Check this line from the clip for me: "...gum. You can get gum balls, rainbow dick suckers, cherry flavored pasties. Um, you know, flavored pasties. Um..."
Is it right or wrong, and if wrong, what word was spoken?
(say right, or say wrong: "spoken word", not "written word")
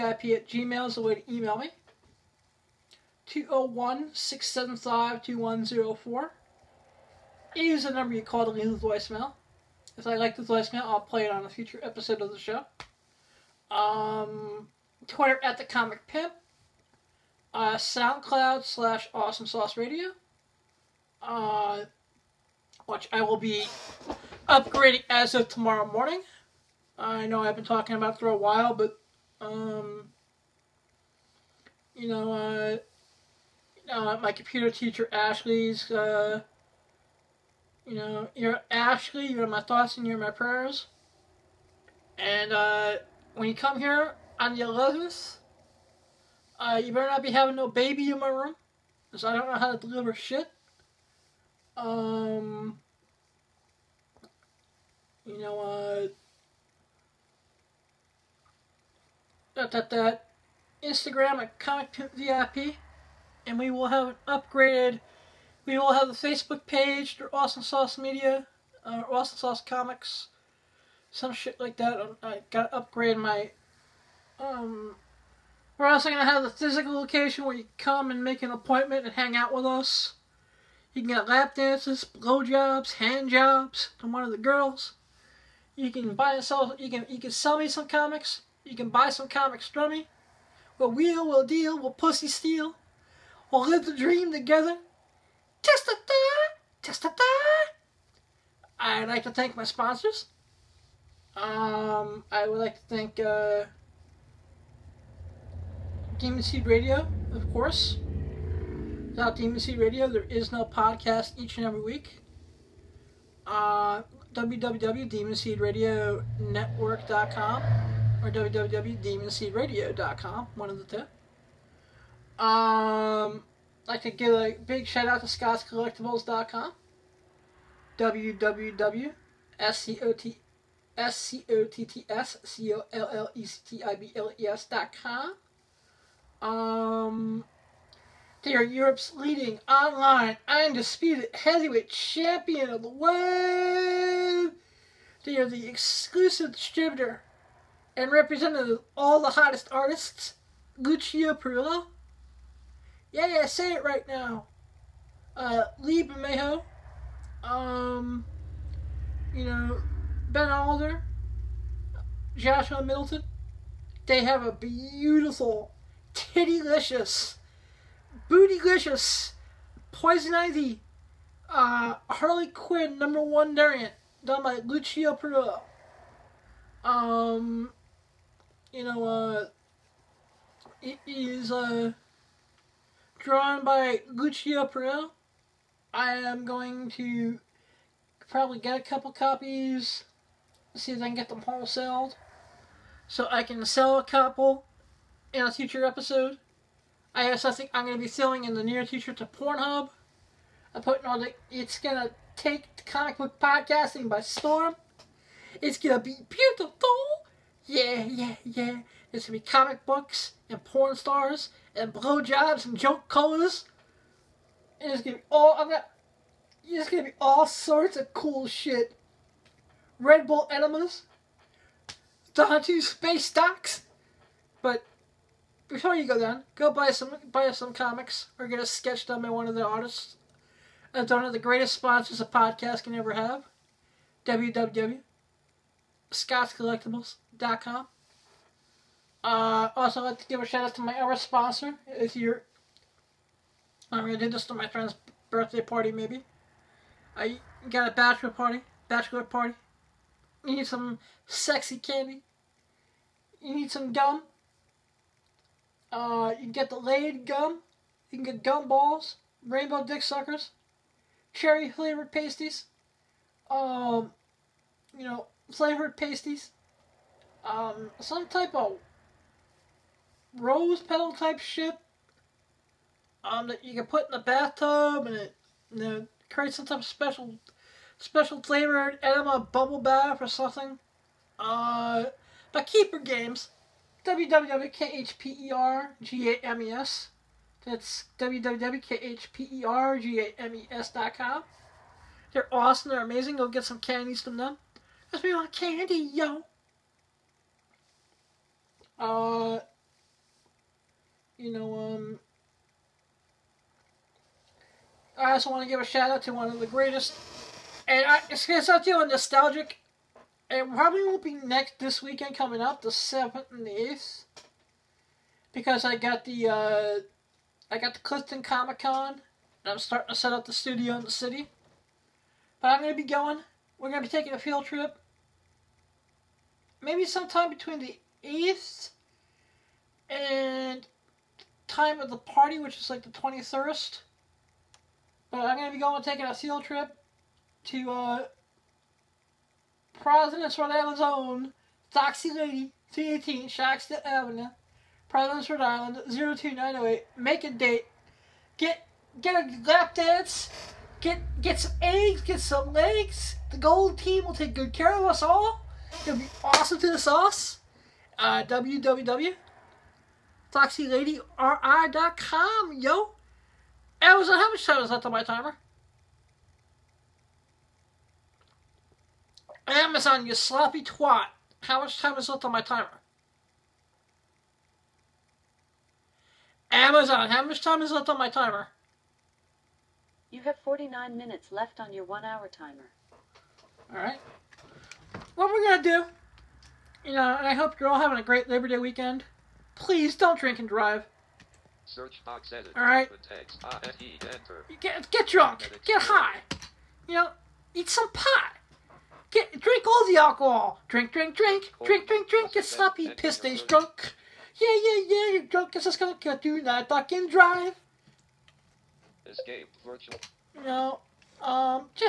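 right.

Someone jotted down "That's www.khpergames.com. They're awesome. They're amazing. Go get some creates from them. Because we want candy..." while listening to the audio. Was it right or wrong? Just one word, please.
wrong.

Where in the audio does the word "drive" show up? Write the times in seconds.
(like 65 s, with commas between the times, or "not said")
390 s, 407 s.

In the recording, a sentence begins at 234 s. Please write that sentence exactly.
www.scottscollectibles.com uh, also, I'd like to give a shout out to my other sponsor.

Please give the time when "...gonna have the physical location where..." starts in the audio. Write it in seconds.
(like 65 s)
76 s.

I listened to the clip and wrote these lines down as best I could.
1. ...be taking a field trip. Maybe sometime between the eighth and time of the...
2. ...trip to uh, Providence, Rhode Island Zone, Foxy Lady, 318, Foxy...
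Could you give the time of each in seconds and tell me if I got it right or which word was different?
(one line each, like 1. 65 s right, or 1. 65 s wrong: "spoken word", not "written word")
1. 324 s right
2. 336 s wrong: "Chalkstone", not "Foxy".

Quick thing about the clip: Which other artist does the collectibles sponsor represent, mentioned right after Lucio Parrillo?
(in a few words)
Lee Bermejo.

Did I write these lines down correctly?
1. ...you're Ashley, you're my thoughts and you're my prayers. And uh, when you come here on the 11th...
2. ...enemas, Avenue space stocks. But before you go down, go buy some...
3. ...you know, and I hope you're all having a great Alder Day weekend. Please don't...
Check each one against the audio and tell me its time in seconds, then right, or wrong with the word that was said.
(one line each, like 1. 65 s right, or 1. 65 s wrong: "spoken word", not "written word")
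1. 38 s right
2. 220 s wrong: "Dante", not "Avenue"
3. 387 s wrong: "Labor", not "Alder".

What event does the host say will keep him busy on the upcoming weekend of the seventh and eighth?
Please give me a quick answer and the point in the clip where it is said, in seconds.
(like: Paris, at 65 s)
Clifton Comic Con, at 318 s.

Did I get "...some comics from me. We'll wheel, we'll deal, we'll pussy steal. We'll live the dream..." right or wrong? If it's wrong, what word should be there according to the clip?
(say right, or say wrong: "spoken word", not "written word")
right.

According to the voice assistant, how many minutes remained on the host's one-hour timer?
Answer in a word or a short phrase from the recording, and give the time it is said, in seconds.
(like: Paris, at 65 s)
49, at 380 s.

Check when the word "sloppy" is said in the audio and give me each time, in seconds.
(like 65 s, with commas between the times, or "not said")
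370 s, 402 s.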